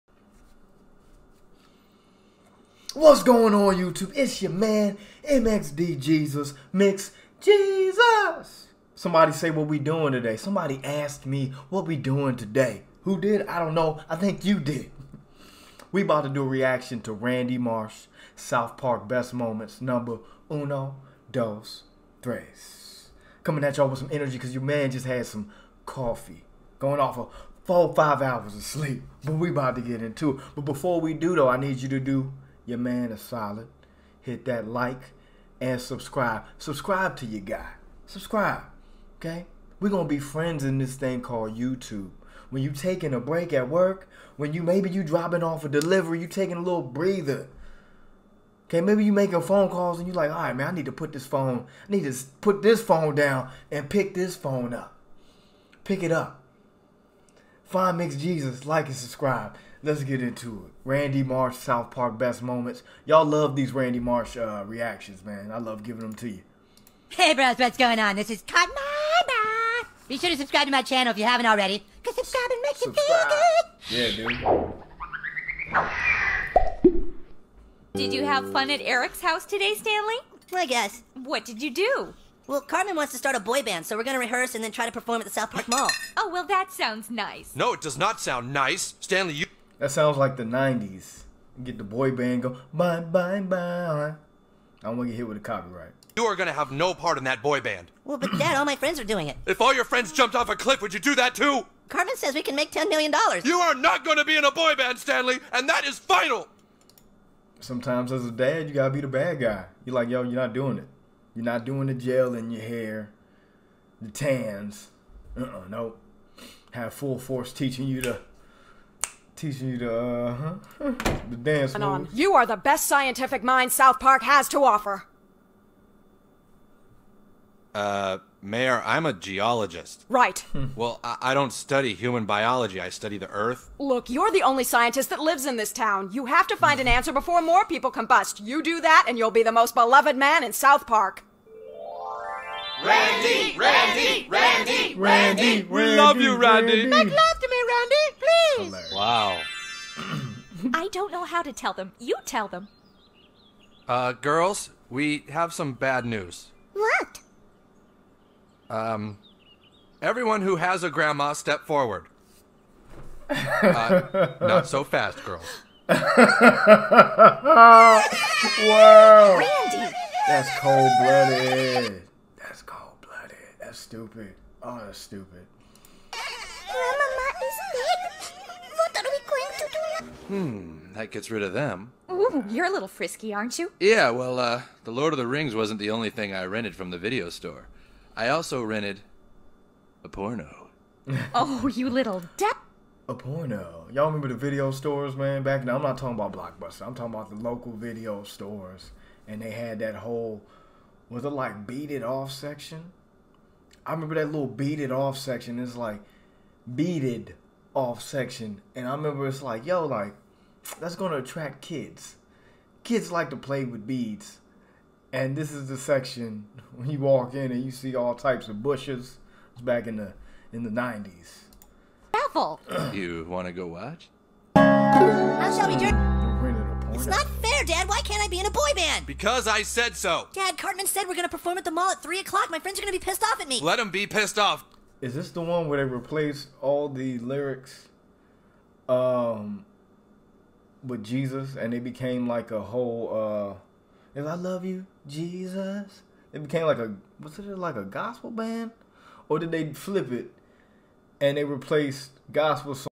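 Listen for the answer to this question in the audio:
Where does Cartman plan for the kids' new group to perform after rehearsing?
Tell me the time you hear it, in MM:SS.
01:25.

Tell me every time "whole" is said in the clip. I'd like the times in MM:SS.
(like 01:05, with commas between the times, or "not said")
03:19, 04:02.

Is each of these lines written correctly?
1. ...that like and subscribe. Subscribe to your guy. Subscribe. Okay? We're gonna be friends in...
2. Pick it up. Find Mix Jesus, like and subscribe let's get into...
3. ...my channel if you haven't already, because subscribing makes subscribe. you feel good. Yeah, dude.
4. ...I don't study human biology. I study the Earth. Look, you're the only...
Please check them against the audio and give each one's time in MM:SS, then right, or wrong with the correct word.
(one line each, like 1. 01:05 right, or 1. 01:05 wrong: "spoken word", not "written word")
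1. 00:34 right
2. 00:55 right
3. 01:10 right
4. 02:11 right.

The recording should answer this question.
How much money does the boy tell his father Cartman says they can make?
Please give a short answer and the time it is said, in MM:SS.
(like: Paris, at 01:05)
$10 million, at 01:42.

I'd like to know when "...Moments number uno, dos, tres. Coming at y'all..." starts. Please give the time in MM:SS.
00:19.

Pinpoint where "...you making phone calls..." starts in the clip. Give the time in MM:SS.
00:49.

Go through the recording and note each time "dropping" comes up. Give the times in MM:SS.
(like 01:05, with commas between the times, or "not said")
00:45.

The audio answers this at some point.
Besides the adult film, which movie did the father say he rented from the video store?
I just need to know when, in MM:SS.
03:04.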